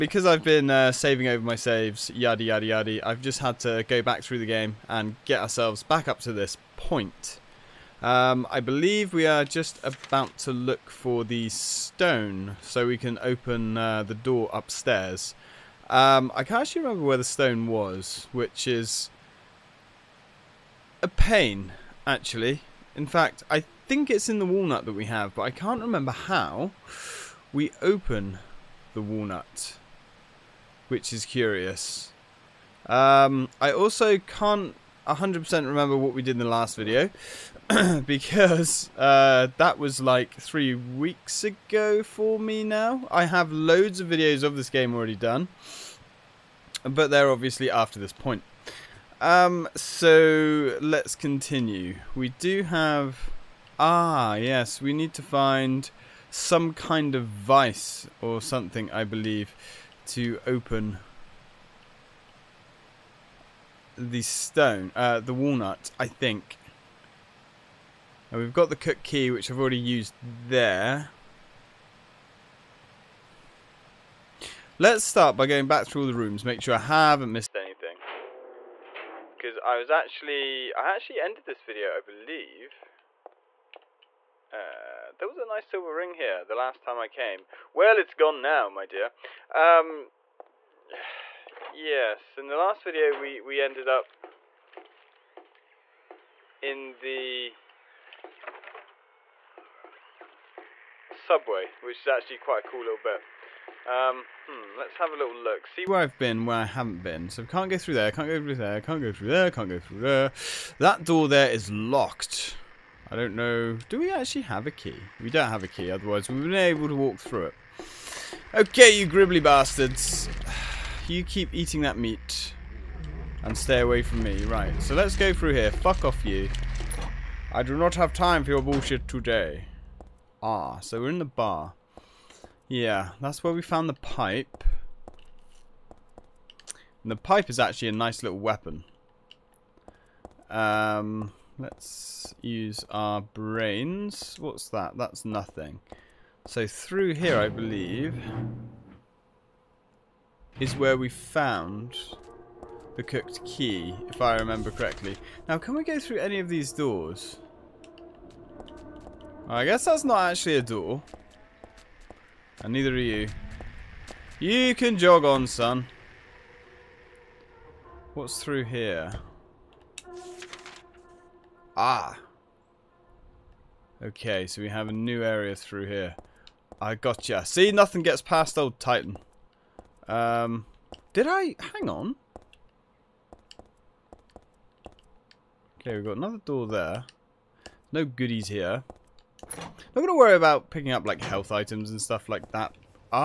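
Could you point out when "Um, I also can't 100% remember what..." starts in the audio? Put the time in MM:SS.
00:32.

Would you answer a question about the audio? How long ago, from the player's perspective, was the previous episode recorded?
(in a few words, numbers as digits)
Three weeks.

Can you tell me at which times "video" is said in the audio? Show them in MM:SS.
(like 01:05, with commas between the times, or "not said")
00:36, 00:44, 01:21, 01:32.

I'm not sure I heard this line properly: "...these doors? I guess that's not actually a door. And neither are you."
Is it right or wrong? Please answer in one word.
right.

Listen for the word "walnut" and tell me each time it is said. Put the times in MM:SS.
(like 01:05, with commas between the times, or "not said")
00:24, 00:29, 01:05.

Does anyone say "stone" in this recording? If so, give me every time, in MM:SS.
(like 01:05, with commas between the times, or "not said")
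00:11, 00:17, 01:04.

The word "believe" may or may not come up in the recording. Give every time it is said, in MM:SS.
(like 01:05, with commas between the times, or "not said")
00:08, 00:59, 01:21, 02:27.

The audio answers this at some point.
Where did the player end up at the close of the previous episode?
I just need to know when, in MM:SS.
01:41.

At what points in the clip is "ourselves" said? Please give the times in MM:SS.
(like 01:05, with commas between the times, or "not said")
00:05.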